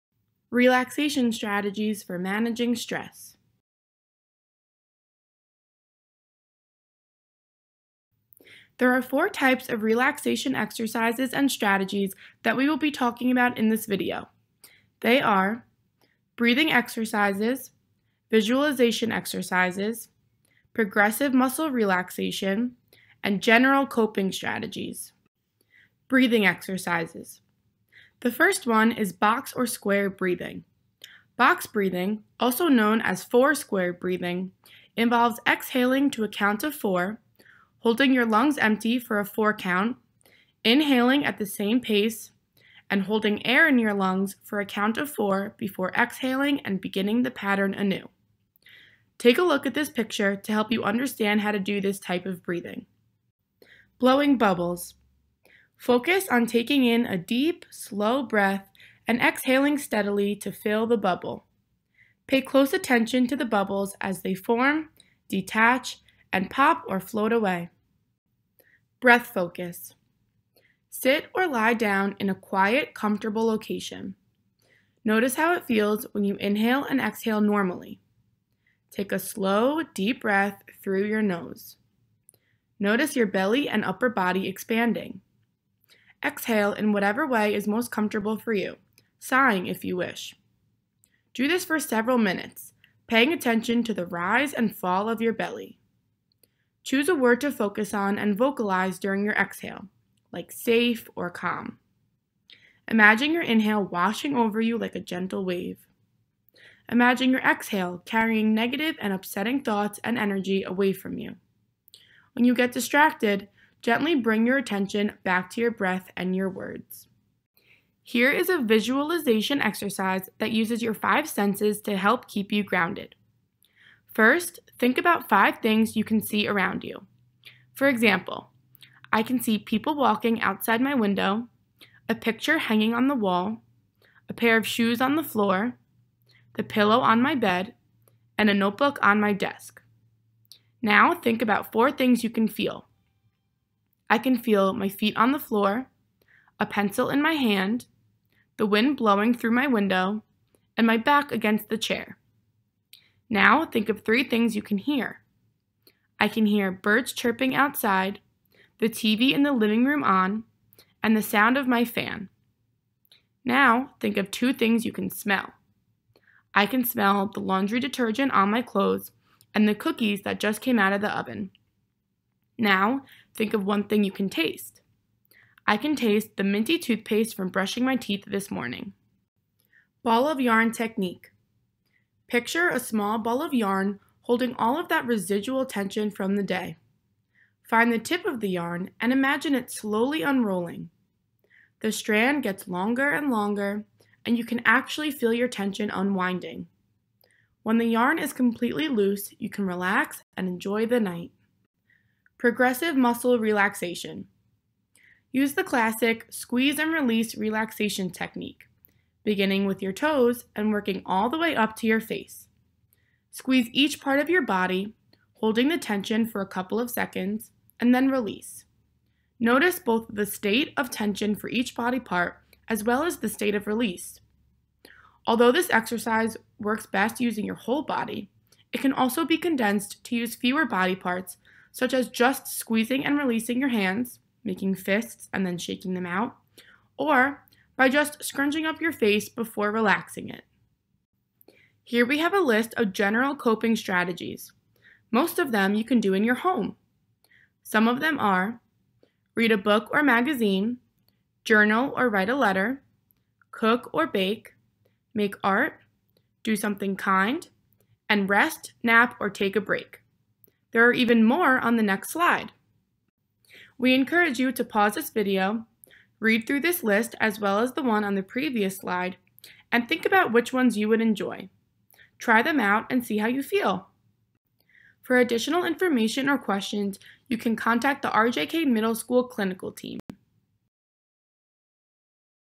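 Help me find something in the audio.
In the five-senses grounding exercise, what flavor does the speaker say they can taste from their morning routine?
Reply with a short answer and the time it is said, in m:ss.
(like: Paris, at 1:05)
minty toothpaste, at 2:56.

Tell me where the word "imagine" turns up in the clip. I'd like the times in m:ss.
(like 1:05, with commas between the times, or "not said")
1:42, 1:46, 3:09.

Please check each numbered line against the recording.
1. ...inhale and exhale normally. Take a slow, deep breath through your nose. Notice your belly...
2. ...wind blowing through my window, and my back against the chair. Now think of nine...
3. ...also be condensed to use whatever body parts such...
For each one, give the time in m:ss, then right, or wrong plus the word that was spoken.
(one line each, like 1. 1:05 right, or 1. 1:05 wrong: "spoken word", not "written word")
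1. 1:16 right
2. 2:28 wrong: "three", not "nine"
3. 3:48 wrong: "fewer", not "whatever".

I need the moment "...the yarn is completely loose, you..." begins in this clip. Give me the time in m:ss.
3:17.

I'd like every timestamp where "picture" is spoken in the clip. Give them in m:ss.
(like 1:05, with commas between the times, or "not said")
0:49, 2:12, 3:02.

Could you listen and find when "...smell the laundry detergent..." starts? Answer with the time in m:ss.
2:46.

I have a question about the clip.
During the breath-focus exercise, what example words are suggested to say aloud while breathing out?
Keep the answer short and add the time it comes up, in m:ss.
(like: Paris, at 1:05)
safe or calm, at 1:40.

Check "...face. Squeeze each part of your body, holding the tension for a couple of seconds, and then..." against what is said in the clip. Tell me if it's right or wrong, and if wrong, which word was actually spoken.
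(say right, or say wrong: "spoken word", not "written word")
right.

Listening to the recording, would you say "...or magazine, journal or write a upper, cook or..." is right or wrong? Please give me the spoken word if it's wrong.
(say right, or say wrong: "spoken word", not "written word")
wrong: "letter", not "upper".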